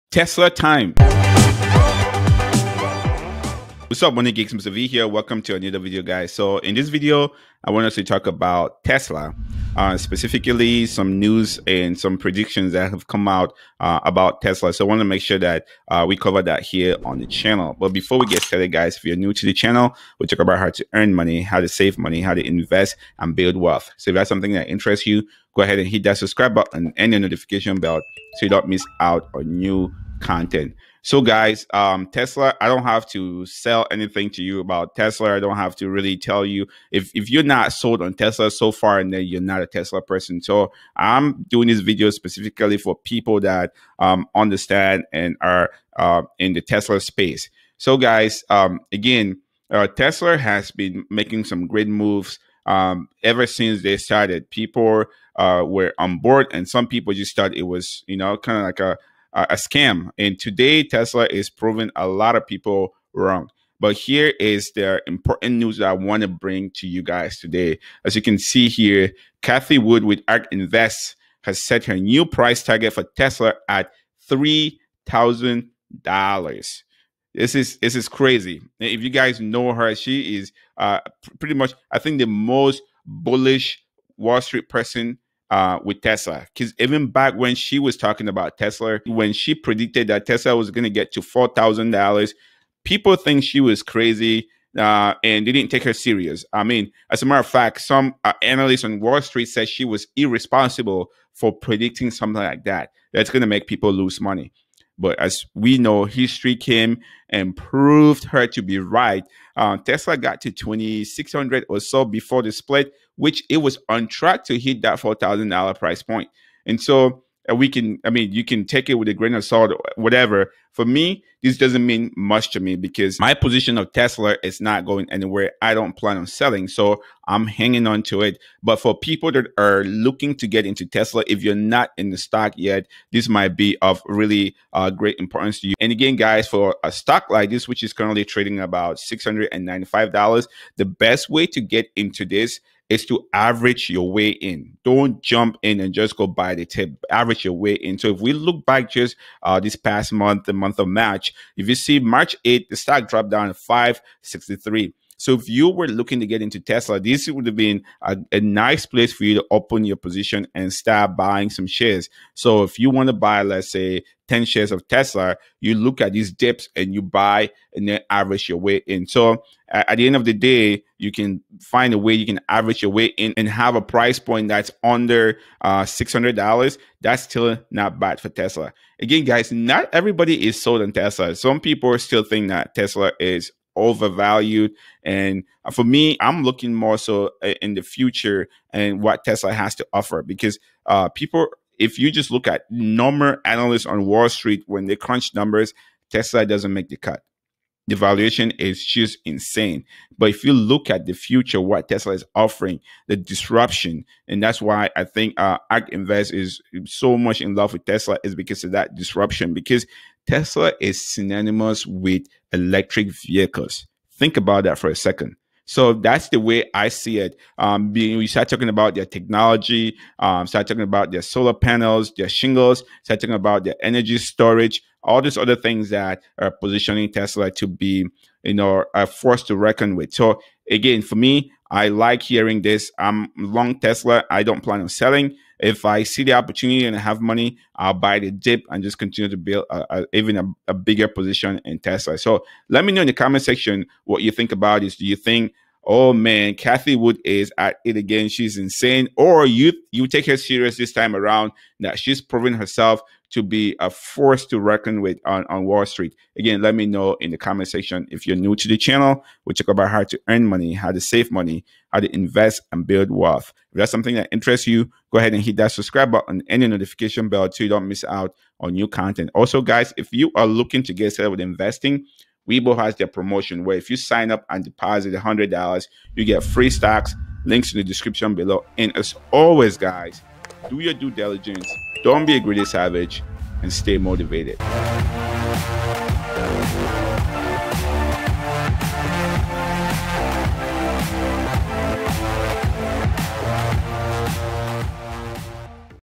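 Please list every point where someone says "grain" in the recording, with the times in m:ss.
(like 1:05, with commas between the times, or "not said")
1:59.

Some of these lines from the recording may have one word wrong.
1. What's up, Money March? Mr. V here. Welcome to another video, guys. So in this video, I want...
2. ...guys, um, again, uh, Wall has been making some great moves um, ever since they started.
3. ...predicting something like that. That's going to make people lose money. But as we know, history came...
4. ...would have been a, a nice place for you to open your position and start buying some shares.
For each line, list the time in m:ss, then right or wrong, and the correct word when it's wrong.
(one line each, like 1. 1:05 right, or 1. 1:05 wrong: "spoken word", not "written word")
1. 0:03 wrong: "Geeks", not "March"
2. 0:47 wrong: "Tesla", not "Wall"
3. 1:41 right
4. 2:37 right.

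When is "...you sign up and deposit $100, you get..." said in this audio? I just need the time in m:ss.
4:33.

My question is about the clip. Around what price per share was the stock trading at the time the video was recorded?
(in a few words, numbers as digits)
$695.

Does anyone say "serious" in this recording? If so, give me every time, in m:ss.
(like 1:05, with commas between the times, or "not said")
1:35, 4:10.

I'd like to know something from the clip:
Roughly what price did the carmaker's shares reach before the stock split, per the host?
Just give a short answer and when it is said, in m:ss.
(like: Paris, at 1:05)
2600, at 1:50.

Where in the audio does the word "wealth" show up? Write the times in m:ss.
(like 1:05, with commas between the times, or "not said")
0:23, 4:23.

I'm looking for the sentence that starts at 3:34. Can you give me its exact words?
Think about that for a second.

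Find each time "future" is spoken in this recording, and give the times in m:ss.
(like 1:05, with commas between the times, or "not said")
3:07, 3:21.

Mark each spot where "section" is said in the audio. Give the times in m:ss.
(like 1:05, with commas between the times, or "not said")
4:03, 4:17.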